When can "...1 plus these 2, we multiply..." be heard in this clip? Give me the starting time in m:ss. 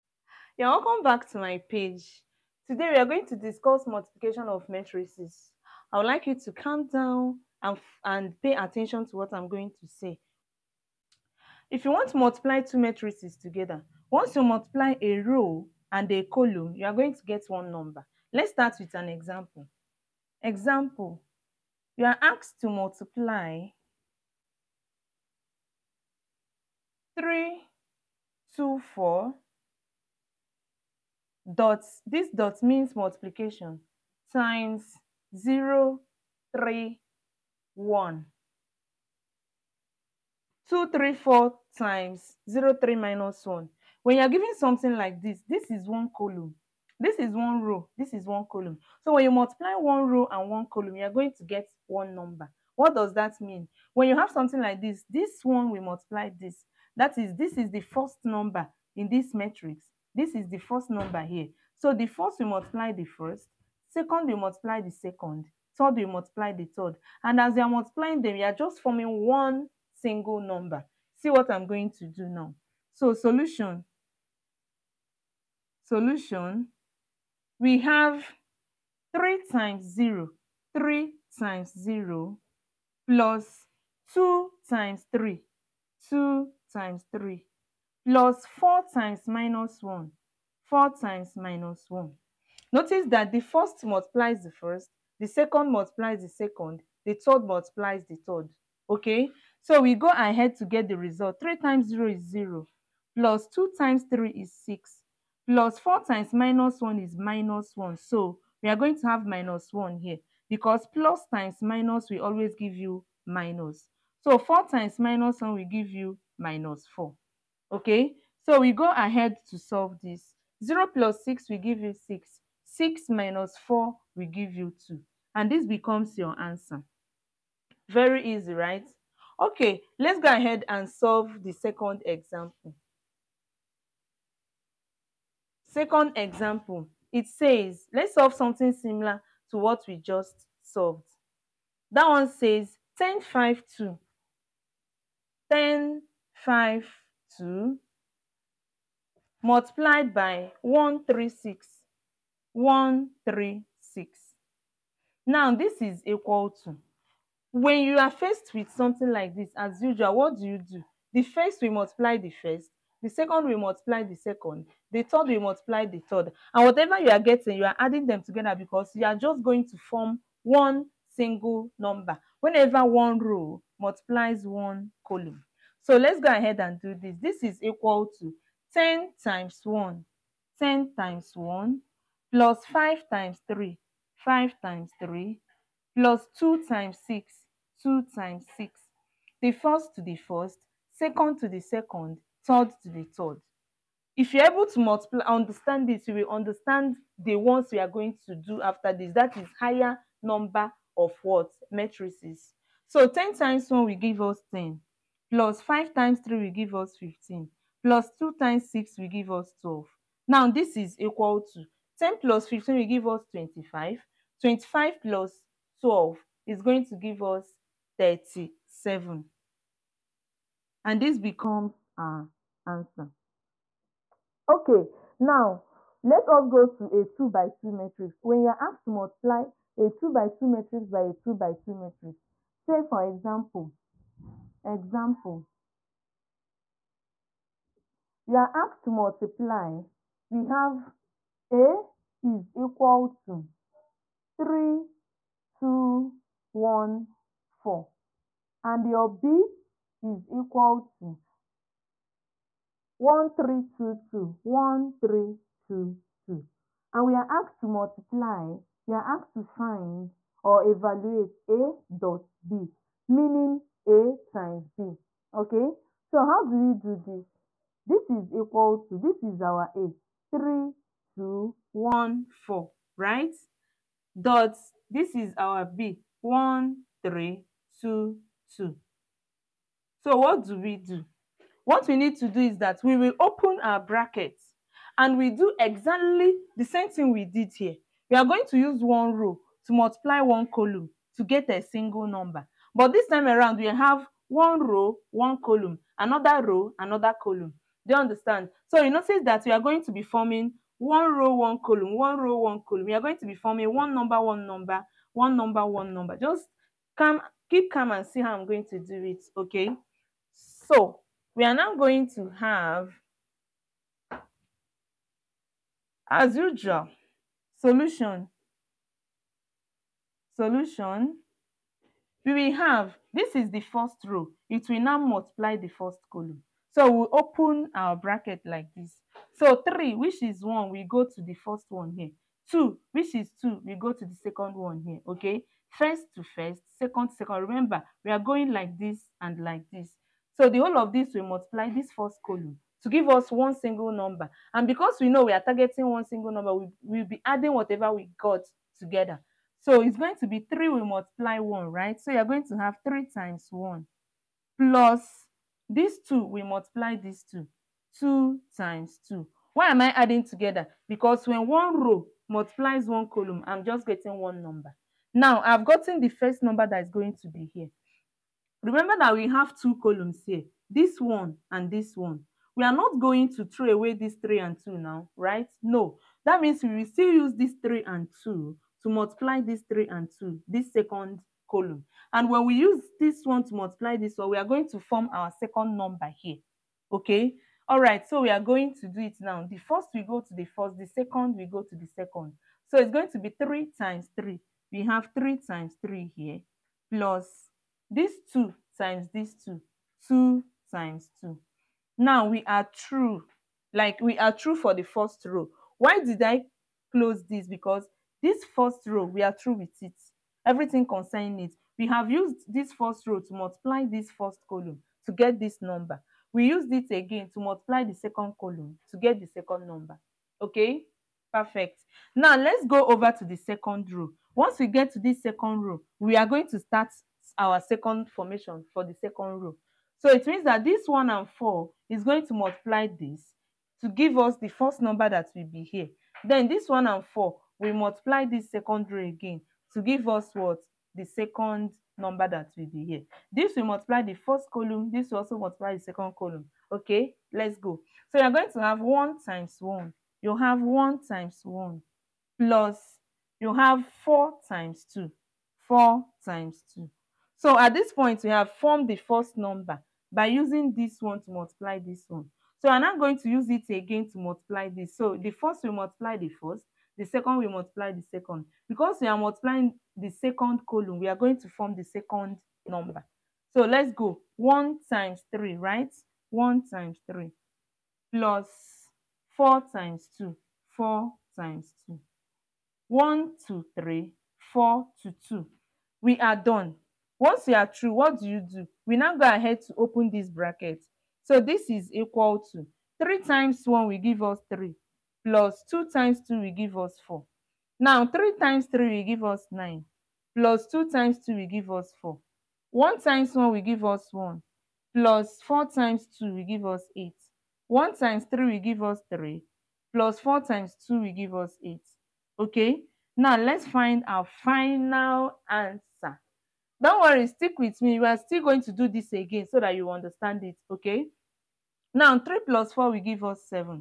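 5:53.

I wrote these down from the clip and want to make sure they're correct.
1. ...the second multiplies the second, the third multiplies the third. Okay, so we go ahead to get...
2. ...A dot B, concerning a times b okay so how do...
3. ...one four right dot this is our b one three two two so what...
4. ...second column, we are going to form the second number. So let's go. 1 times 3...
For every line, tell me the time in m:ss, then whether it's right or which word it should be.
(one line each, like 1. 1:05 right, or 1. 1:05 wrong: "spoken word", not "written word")
1. 1:35 right
2. 4:21 wrong: "meaning", not "concerning"
3. 4:31 right
4. 7:50 right.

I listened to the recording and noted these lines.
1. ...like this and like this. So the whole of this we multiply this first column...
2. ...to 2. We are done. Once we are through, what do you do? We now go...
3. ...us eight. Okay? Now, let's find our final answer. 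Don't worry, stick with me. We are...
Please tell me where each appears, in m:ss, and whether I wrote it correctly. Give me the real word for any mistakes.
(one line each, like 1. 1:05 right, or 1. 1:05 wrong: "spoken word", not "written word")
1. 5:38 right
2. 8:05 right
3. 8:31 right.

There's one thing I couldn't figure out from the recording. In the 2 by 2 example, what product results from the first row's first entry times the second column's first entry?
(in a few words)
9.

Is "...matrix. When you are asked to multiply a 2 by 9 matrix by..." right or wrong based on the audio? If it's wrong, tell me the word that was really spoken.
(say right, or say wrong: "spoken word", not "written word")
wrong: "2", not "9".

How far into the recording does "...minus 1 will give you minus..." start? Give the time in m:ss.
1:54.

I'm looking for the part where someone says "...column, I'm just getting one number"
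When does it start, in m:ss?
6:03.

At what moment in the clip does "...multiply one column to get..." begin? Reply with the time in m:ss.
4:49.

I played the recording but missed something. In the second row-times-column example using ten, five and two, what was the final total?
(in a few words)
37.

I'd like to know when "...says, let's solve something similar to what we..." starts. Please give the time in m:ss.
2:17.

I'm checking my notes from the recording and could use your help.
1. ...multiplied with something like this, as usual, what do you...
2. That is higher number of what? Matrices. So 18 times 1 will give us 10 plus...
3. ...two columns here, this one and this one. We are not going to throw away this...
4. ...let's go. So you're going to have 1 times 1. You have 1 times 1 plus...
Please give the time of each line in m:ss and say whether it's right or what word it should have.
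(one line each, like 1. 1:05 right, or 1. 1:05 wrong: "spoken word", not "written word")
1. 2:38 wrong: "faced", not "multiplied"
2. 3:19 wrong: "10", not "18"
3. 6:09 right
4. 7:27 right.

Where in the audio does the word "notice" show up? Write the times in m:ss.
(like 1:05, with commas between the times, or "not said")
1:32, 4:58.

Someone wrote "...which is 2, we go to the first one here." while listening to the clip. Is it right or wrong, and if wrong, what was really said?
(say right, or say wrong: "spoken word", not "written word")
wrong: "1", not "2".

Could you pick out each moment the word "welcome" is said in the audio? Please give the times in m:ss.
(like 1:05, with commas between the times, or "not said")
0:00.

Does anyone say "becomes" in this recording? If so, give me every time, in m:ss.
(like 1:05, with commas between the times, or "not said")
2:05, 3:41.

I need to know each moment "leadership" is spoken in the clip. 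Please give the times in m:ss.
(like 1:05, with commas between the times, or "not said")
not said.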